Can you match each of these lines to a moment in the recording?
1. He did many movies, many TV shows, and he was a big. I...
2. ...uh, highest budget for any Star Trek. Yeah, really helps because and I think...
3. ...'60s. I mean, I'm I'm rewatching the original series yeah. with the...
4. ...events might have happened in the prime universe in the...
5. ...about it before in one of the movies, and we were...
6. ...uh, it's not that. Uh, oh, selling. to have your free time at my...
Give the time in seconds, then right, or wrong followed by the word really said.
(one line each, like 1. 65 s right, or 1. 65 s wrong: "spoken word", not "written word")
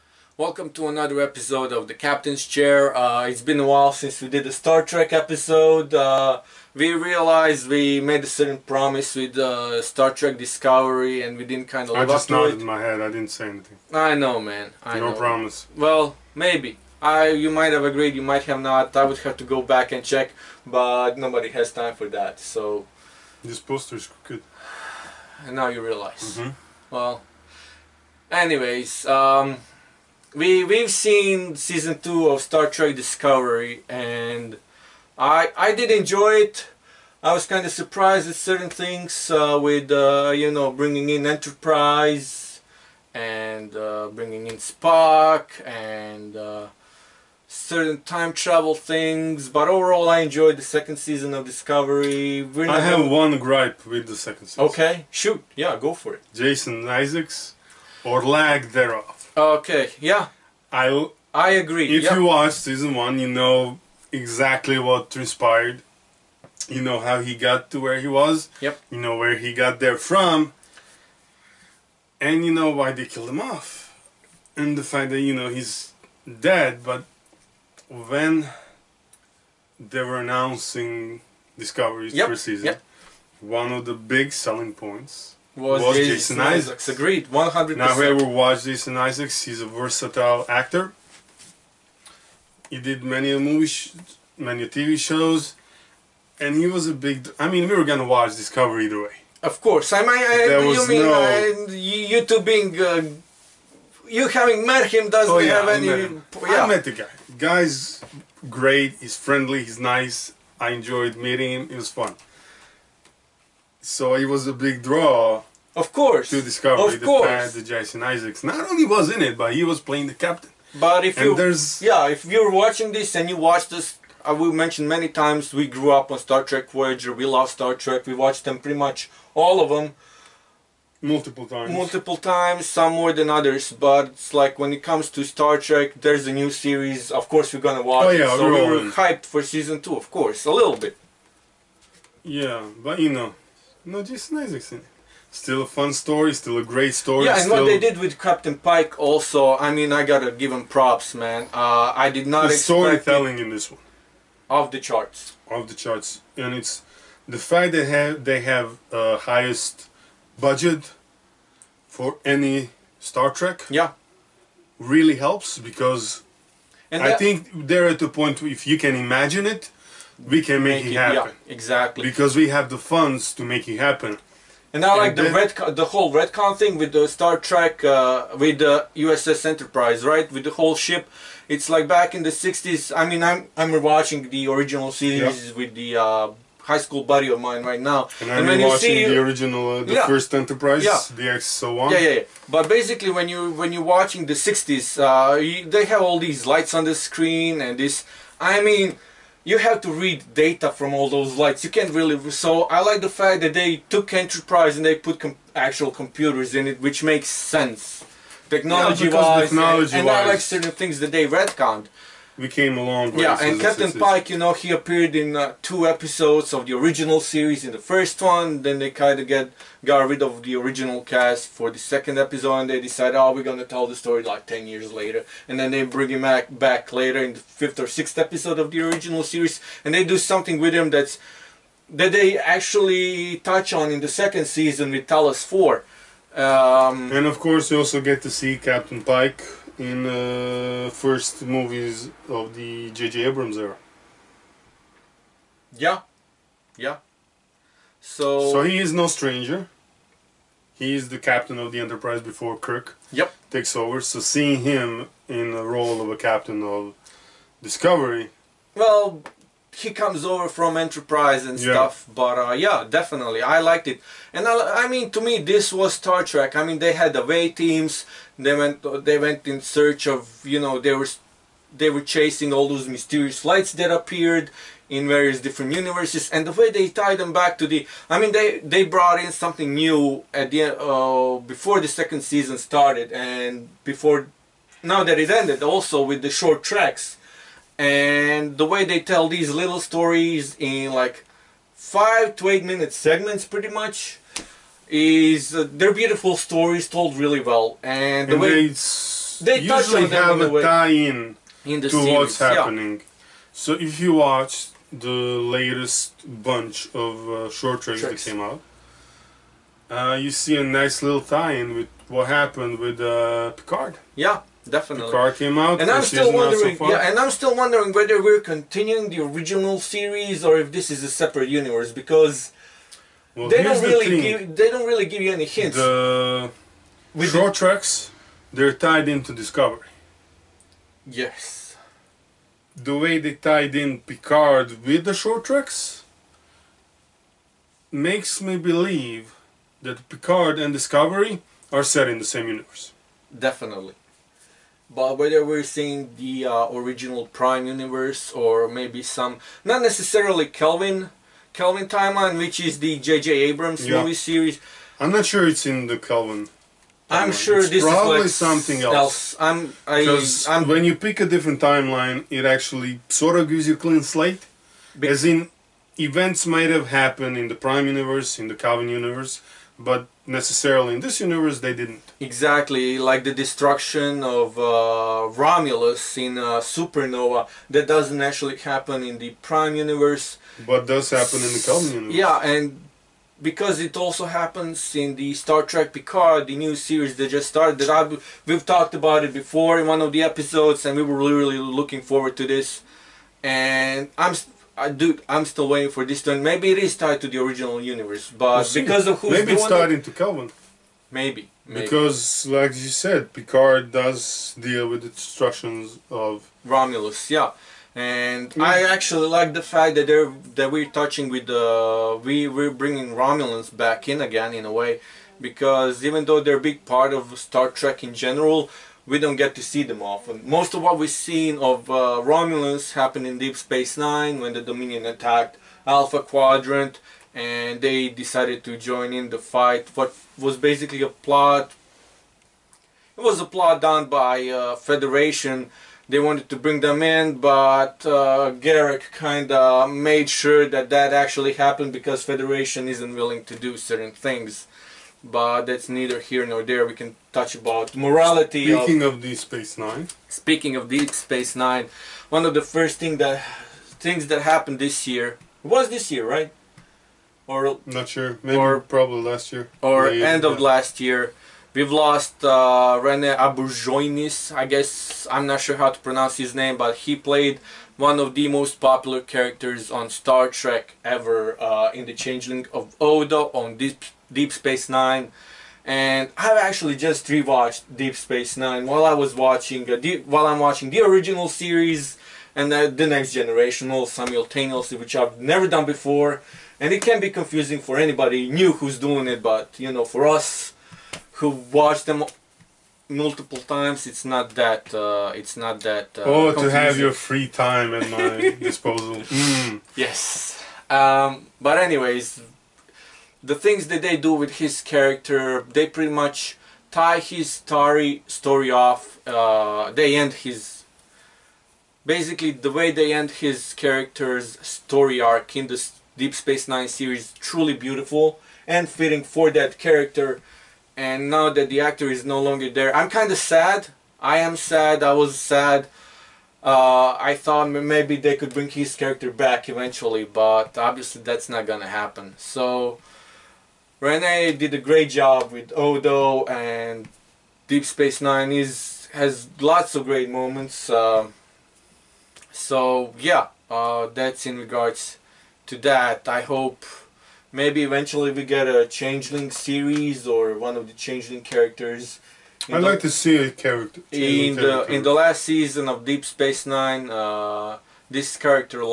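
1. 92 s right
2. 158 s right
3. 182 s right
4. 365 s right
5. 388 s wrong: "episodes", not "movies"
6. 494 s wrong: "confusing", not "selling".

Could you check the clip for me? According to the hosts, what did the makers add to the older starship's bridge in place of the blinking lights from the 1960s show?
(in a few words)
Actual computers.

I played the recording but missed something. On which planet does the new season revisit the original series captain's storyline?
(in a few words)
Talos Four.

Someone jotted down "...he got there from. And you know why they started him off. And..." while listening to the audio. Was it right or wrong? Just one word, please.
wrong.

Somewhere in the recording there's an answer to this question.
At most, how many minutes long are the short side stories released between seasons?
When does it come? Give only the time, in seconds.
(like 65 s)
291 s.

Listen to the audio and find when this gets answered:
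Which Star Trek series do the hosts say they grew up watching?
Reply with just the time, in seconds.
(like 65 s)
126 s.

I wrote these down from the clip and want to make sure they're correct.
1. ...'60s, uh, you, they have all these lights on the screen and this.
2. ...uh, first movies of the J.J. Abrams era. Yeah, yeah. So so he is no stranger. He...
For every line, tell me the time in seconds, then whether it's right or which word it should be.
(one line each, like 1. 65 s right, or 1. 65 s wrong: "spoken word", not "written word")
1. 194 s right
2. 240 s right.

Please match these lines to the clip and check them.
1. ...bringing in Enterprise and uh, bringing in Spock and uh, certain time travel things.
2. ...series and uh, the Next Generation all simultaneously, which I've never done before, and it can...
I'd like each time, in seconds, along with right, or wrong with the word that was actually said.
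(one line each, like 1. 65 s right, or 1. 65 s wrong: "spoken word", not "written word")
1. 40 s right
2. 481 s right.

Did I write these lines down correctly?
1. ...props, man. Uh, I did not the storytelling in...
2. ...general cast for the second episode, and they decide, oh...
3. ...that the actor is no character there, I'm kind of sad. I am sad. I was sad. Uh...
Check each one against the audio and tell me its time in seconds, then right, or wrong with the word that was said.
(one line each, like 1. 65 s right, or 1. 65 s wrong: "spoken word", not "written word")
1. 150 s right
2. 220 s wrong: "original", not "general"
3. 521 s wrong: "longer", not "character".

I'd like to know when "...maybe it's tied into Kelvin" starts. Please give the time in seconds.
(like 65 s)
399 s.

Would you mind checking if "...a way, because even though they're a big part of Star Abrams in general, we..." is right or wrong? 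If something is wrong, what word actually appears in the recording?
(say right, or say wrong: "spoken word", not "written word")
wrong: "Trek", not "Abrams".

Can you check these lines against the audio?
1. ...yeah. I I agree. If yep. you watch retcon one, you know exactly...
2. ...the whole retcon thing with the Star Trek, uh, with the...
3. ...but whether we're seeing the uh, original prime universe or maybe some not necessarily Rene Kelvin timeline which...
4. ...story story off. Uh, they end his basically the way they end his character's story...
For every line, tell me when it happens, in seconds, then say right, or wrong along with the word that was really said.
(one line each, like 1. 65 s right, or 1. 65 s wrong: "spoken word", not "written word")
1. 59 s wrong: "season", not "retcon"
2. 175 s right
3. 344 s wrong: "Kelvin", not "Rene"
4. 507 s right.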